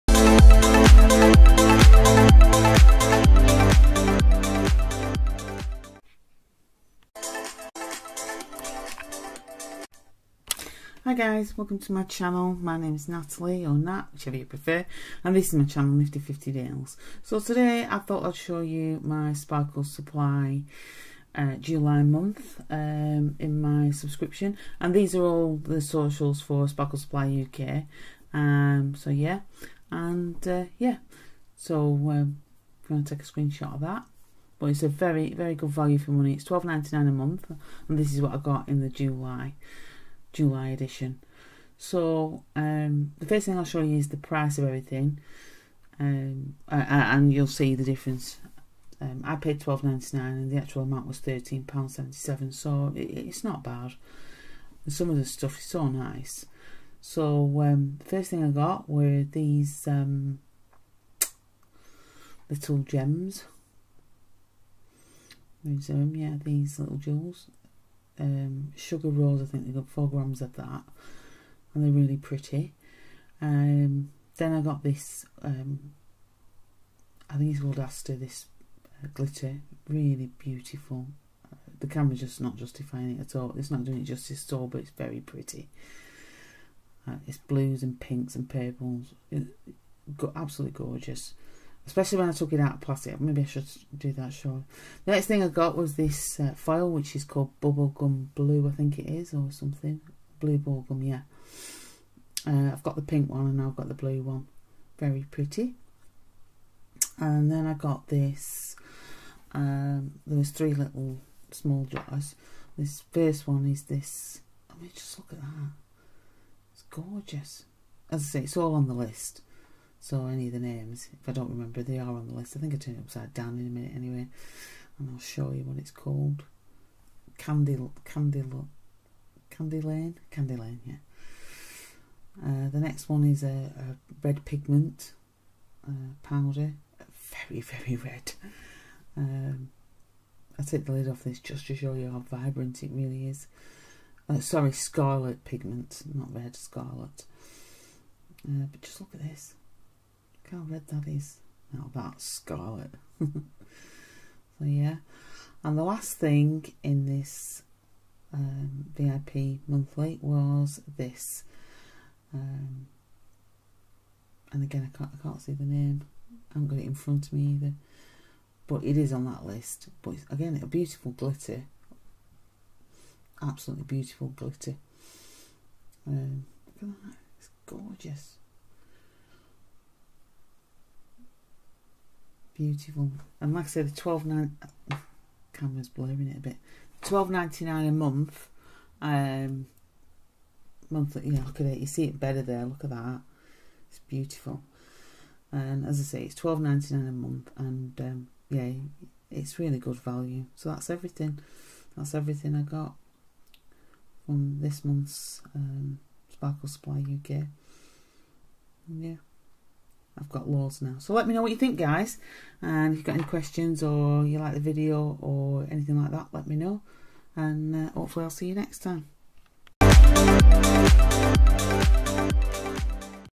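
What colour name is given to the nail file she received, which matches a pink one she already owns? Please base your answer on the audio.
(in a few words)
Bubblegum Blue.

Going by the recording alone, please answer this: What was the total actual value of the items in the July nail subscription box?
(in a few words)
£13.77.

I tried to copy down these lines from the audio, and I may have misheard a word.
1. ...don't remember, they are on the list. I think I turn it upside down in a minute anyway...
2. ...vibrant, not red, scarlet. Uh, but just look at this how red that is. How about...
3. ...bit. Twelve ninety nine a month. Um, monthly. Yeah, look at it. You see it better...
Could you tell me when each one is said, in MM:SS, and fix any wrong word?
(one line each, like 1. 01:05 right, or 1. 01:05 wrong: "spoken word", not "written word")
1. 02:01 right
2. 02:25 wrong: "pigment", not "vibrant"
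3. 03:06 right.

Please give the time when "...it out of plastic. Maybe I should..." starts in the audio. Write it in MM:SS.
01:32.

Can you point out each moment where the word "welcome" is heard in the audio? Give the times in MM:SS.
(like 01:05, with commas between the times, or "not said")
00:11.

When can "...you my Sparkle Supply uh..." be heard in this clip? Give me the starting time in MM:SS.
00:18.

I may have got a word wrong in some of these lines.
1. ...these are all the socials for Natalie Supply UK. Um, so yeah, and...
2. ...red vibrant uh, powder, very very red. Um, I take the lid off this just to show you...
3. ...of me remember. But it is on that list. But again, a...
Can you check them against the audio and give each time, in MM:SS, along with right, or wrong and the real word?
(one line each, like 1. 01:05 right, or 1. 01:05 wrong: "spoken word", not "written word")
1. 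00:24 wrong: "Sparkle", not "Natalie"
2. 02:14 wrong: "pigment", not "vibrant"
3. 02:47 wrong: "either", not "remember".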